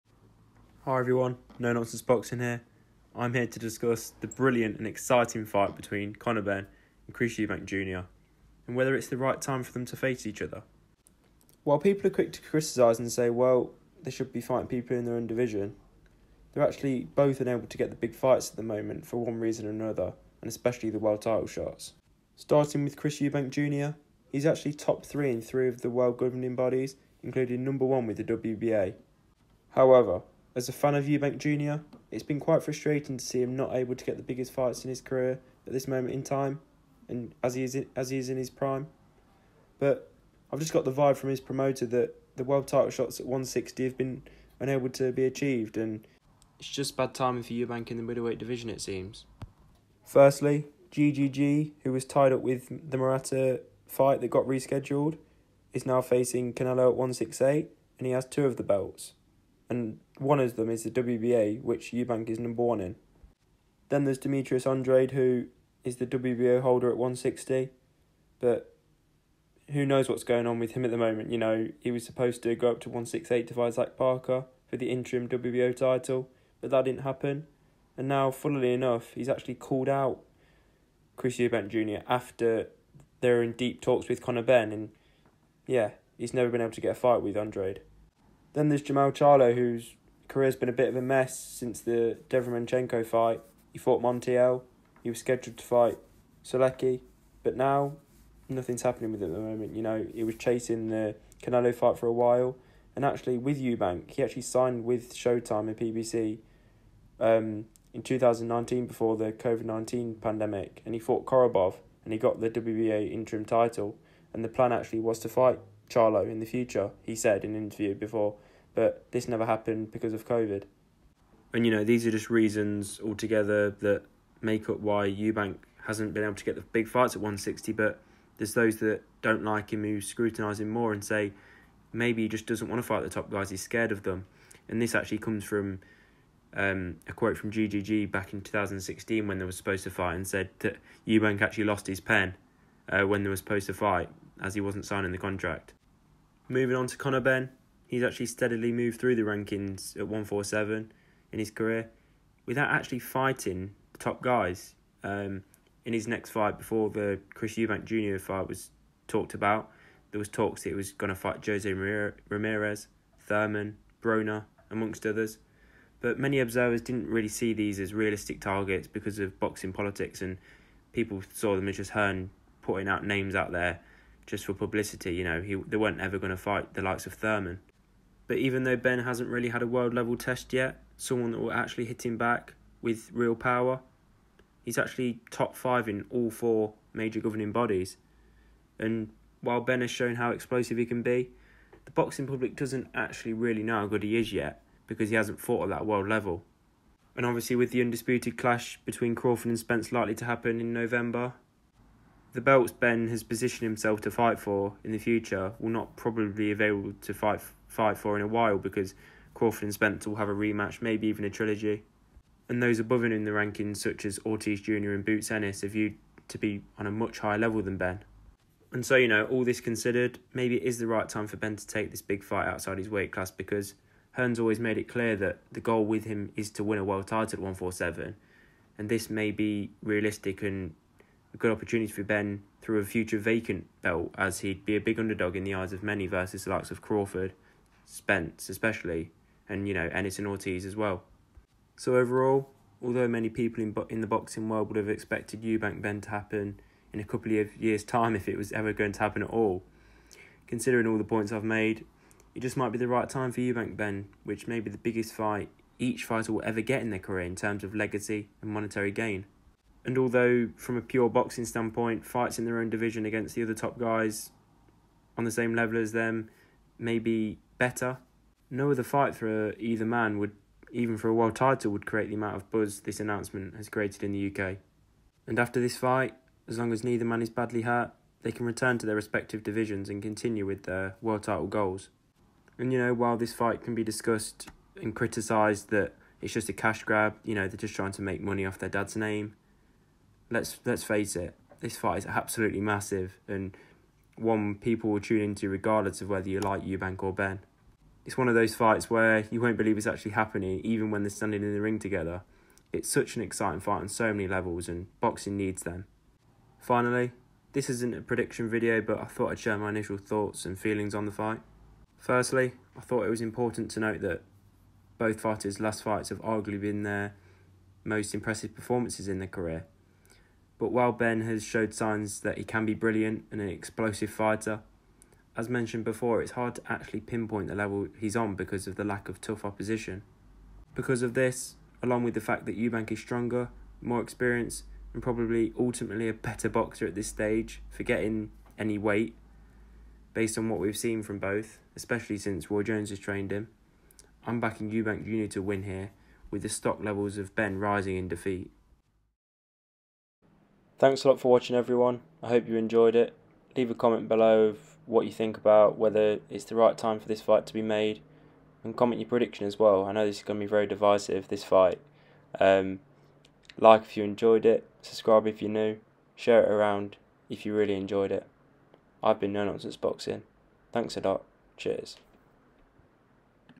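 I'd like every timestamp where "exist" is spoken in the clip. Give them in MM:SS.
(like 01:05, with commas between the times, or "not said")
not said.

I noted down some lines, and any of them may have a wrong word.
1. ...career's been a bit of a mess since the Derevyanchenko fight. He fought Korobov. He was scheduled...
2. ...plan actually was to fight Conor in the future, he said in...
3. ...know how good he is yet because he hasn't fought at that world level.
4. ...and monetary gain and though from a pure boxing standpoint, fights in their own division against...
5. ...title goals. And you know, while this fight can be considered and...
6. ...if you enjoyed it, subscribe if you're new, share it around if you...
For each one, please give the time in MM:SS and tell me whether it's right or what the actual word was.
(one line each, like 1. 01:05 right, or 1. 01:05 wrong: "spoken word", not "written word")
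1. 01:30 wrong: "Montiel", not "Korobov"
2. 01:54 wrong: "Charlo", not "Conor"
3. 03:13 right
4. 04:18 wrong: "although", not "though"
5. 04:41 wrong: "discussed", not "considered"
6. 06:03 right.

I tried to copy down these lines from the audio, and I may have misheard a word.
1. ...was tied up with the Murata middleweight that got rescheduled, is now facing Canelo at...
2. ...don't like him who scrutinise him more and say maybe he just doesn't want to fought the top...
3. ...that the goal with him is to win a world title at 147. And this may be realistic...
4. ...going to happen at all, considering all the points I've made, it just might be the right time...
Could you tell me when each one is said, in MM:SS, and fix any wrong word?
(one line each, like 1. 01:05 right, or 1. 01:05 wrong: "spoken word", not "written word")
1. 00:51 wrong: "fight", not "middleweight"
2. 02:09 wrong: "fight", not "fought"
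3. 03:45 right
4. 04:08 right.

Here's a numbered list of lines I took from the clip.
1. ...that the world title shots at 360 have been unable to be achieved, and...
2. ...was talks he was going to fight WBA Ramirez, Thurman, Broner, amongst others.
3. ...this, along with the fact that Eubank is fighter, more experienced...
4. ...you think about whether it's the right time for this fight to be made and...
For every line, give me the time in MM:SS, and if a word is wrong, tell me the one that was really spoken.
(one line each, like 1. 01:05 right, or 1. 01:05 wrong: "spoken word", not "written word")
1. 00:41 wrong: "160", not "360"
2. 02:40 wrong: "Jose", not "WBA"
3. 05:31 wrong: "stronger", not "fighter"
4. 05:55 right.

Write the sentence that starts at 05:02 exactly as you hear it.
It's such an exciting fight on so many levels and boxing needs them.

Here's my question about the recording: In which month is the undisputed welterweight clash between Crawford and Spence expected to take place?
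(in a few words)
November.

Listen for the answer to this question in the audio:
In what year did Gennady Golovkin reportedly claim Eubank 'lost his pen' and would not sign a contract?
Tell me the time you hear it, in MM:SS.
02:18.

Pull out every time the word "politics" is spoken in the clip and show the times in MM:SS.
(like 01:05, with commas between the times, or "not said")
02:49.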